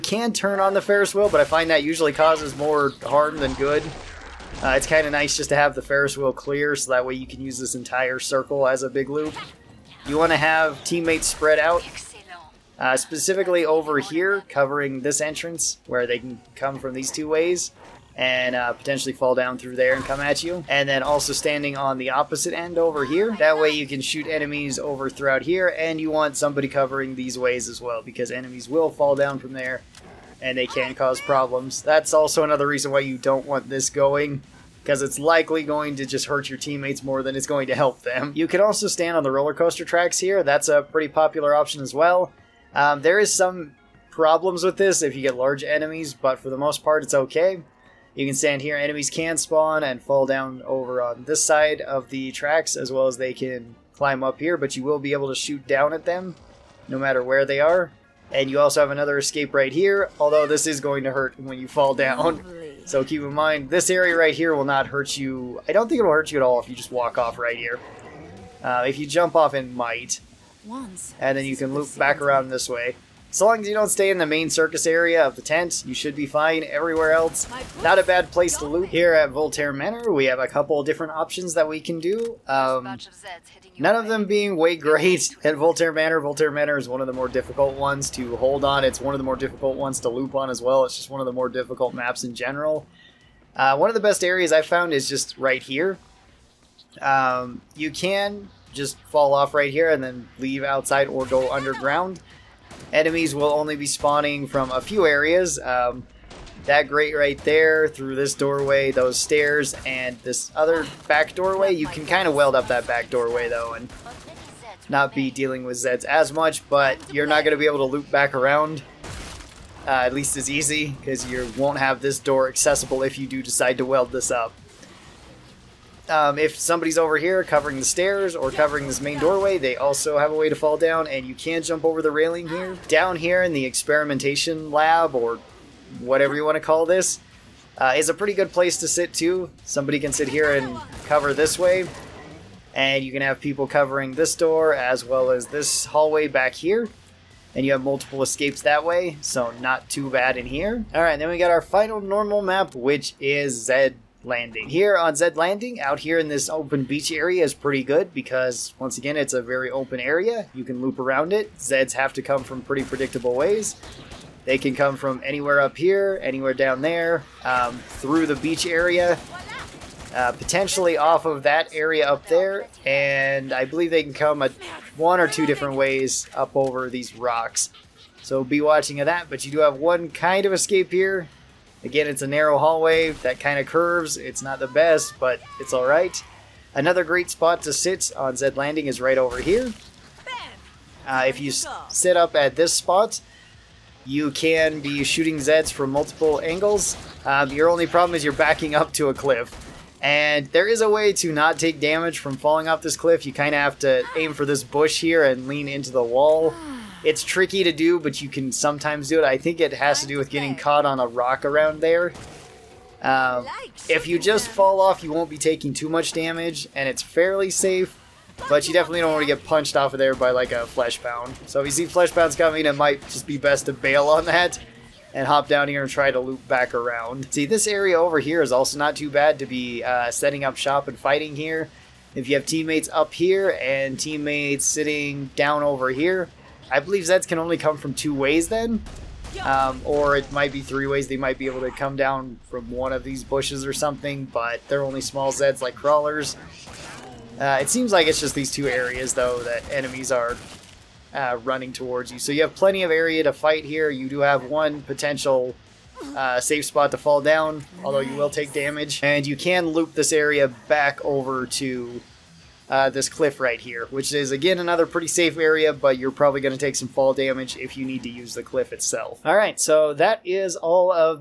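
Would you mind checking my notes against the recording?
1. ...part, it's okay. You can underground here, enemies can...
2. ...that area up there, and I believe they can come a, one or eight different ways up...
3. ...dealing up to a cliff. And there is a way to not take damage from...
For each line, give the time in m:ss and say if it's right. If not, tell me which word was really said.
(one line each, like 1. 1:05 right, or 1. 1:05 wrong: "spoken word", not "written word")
1. 0:46 wrong: "stand", not "underground"
2. 2:51 wrong: "two", not "eight"
3. 3:18 wrong: "backing", not "dealing".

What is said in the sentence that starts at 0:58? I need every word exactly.
And you also have another escape right here, although this is going to hurt when you fall down.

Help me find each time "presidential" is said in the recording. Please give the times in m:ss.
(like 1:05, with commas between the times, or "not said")
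not said.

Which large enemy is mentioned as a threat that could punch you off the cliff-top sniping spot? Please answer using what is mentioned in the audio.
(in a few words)
fleshpound.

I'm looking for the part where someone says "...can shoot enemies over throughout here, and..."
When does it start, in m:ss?
0:23.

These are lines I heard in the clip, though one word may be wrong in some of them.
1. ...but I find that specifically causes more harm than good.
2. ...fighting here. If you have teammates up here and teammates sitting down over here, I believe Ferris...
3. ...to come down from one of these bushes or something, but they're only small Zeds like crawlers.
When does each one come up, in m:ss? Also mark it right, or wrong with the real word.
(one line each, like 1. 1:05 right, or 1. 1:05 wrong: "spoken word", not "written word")
1. 0:01 wrong: "usually", not "specifically"
2. 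3:50 wrong: "Zeds", not "Ferris"
3. 4:01 right.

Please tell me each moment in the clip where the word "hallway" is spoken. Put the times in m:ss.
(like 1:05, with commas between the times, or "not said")
2:25, 3:02.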